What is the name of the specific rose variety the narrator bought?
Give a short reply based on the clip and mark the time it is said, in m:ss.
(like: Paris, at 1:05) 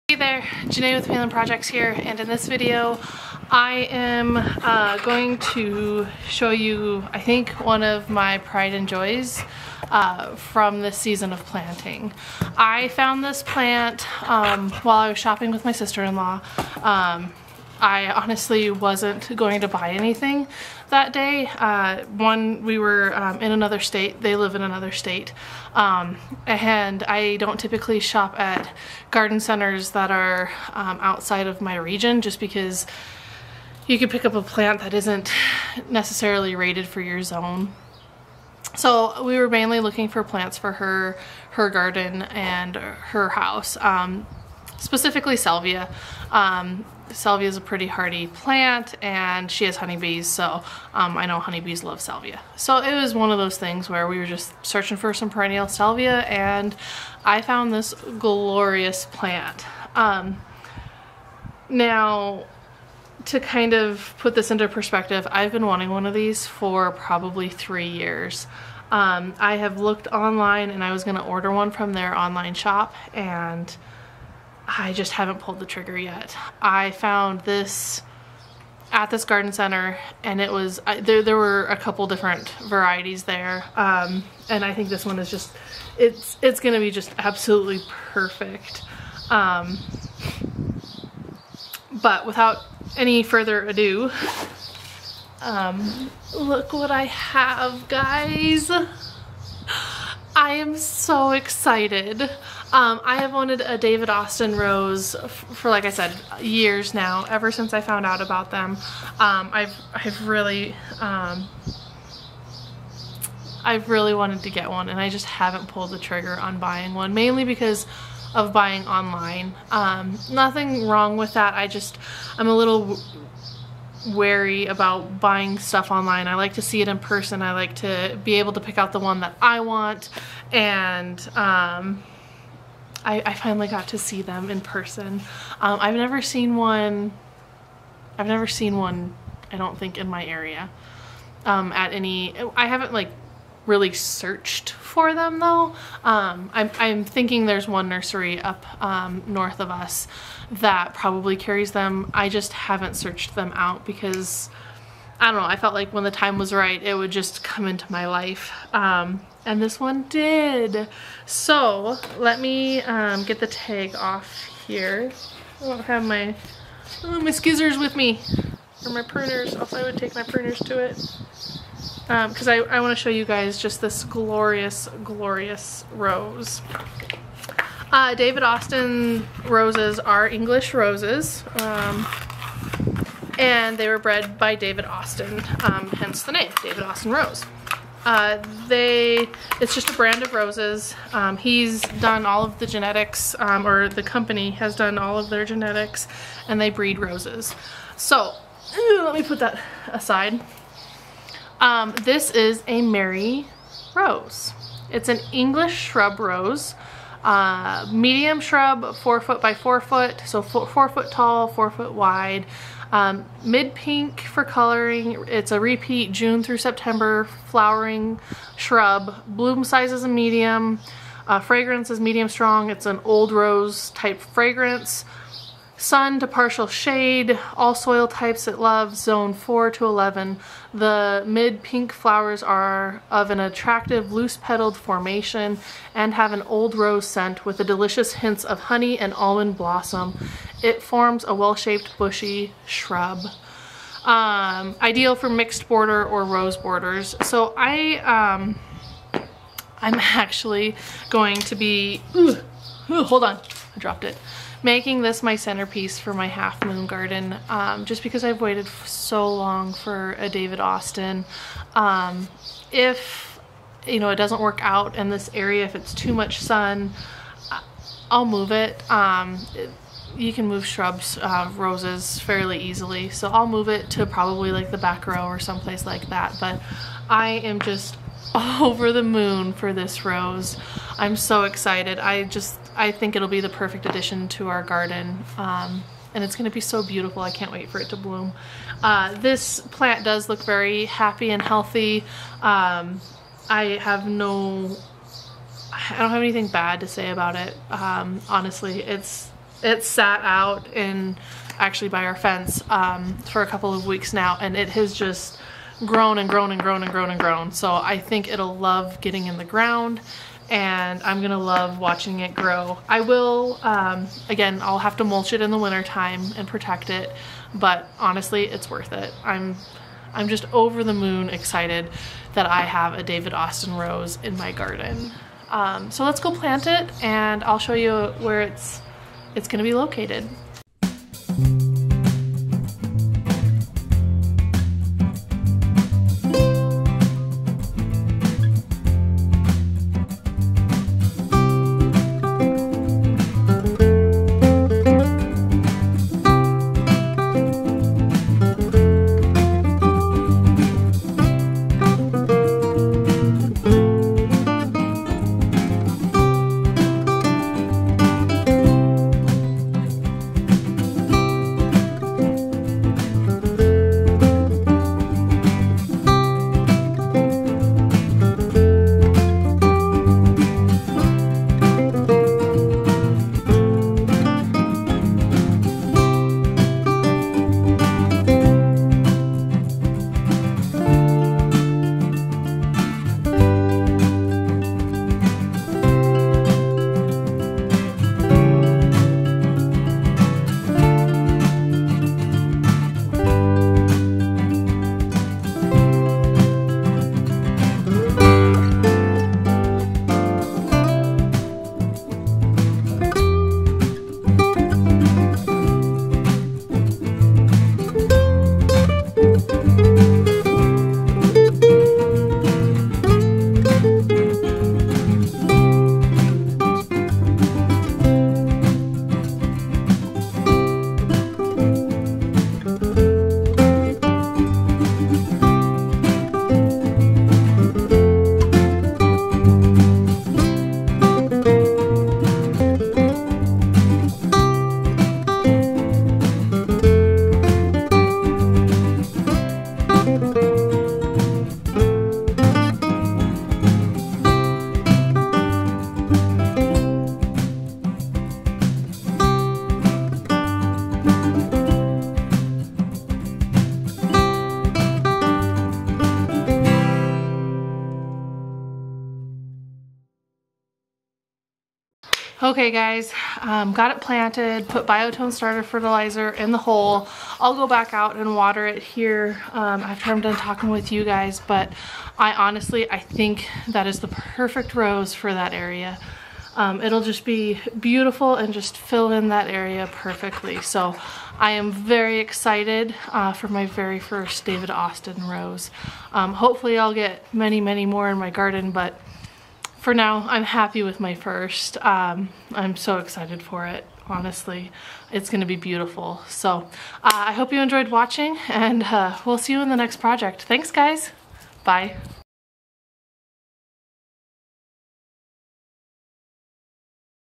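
Mary Rose, at 3:22.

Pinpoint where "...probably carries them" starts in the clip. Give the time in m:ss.
2:30.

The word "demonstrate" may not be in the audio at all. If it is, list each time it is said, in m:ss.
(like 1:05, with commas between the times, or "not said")
not said.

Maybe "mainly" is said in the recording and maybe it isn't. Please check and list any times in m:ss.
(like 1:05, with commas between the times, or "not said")
0:39, 1:57.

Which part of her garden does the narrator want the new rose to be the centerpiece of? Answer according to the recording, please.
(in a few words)
Half moon garden.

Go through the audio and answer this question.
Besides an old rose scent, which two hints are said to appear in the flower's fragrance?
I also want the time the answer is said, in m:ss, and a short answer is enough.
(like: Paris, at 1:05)
Honey and almond blossom, at 3:58.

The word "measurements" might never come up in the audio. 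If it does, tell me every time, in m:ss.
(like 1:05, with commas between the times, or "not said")
not said.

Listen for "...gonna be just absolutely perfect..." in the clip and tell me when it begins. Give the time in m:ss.
1:26.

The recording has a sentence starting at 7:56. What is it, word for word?
Um, it'll just be beautiful and just fill in that area perfectly.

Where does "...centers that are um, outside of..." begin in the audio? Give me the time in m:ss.
0:29.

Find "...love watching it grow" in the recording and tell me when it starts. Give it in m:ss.
5:11.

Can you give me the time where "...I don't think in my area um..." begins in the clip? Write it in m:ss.
2:19.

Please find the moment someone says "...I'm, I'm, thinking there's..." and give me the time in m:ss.
2:26.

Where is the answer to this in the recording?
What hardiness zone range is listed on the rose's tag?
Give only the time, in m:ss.
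3:49.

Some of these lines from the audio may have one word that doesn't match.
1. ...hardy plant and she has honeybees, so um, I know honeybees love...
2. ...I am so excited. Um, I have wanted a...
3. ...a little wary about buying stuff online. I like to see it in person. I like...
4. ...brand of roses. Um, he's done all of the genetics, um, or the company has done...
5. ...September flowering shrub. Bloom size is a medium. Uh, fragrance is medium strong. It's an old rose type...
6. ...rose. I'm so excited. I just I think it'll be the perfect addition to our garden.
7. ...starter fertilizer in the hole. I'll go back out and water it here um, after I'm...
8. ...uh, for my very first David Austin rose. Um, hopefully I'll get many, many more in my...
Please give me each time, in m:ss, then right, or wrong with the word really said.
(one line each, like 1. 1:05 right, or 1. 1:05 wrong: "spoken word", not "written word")
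1. 0:47 right
2. 1:40 right
3. 2:02 right
4. 3:09 right
5. 3:36 right
6. 4:40 right
7. 7:45 right
8. 8:03 right.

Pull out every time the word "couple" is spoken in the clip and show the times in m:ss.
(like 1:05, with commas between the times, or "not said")
1:21, 5:03.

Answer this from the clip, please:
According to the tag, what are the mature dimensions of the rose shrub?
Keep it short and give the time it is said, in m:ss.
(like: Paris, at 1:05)
4 feet by 4 feet, at 3:28.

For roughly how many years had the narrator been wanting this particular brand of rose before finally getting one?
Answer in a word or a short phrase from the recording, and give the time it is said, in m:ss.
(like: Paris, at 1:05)
3 years, at 1:07.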